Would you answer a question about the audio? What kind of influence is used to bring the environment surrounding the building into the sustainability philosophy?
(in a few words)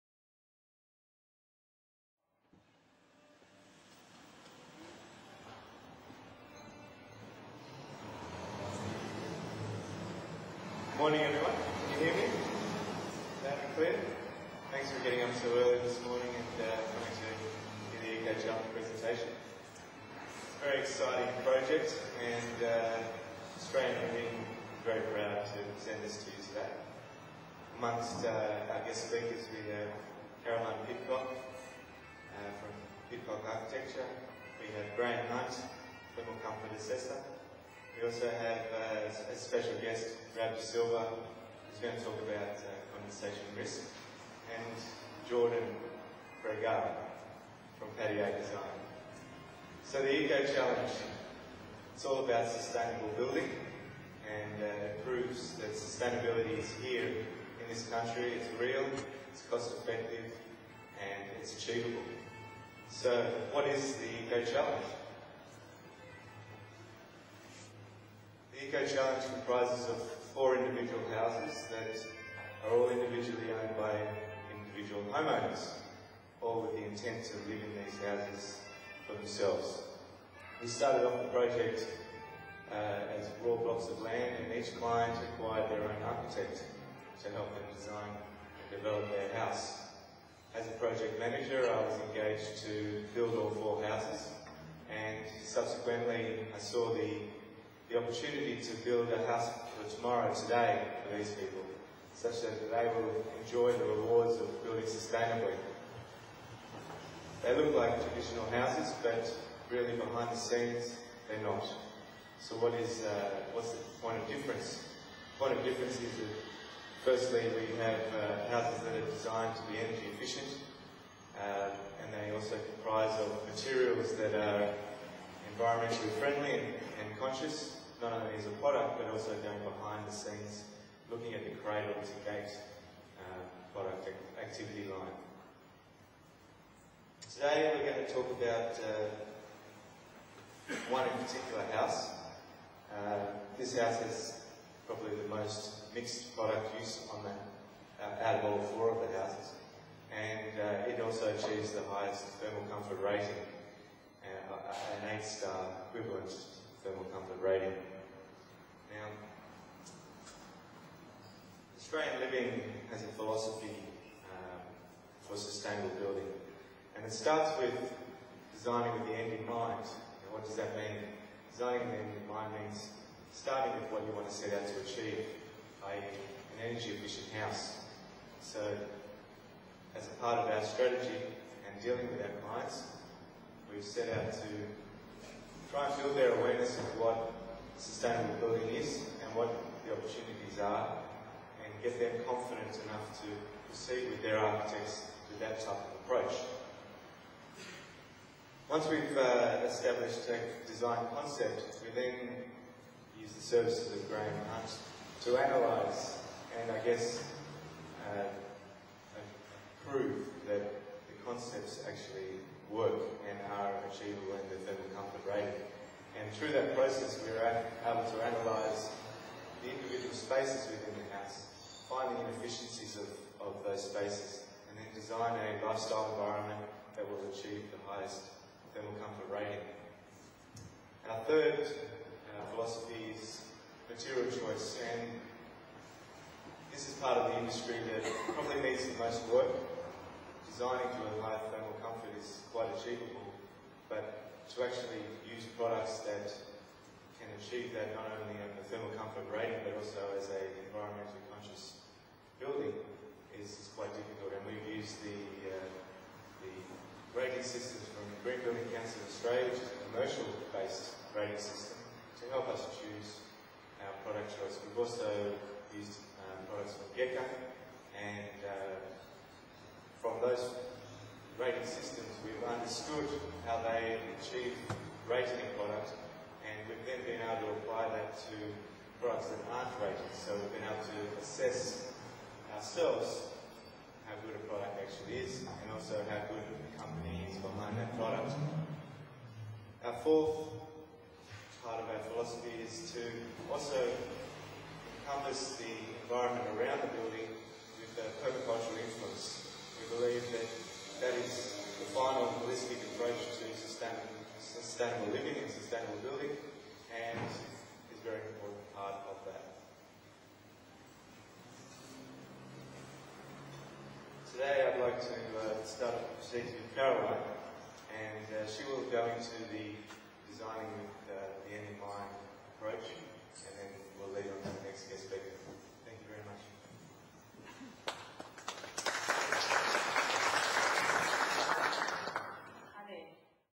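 permacultural.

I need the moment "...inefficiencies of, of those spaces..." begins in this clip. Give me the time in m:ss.
3:42.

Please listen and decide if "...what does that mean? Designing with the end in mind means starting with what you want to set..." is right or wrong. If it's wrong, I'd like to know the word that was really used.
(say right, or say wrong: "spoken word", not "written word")
right.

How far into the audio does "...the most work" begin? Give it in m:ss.
3:58.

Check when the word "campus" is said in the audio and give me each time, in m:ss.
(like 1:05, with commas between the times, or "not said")
not said.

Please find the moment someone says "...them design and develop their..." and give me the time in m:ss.
1:27.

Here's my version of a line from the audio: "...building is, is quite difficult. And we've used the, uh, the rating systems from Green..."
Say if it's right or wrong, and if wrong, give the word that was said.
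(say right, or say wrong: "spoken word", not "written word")
right.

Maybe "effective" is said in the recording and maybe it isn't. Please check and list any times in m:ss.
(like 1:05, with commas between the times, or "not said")
0:59.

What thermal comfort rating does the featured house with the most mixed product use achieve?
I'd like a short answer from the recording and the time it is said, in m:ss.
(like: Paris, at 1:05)
8-star, at 2:35.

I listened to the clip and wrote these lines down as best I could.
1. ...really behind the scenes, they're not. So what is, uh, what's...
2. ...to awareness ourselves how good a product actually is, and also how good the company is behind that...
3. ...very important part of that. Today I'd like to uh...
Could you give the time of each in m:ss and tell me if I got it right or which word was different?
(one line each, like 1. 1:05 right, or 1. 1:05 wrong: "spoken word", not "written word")
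1. 1:49 right
2. 4:40 wrong: "assess", not "awareness"
3. 5:08 right.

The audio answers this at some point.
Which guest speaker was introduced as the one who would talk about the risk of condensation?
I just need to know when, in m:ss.
0:40.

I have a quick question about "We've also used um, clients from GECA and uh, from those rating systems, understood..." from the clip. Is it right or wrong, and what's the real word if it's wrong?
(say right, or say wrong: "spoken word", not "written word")
wrong: "products", not "clients".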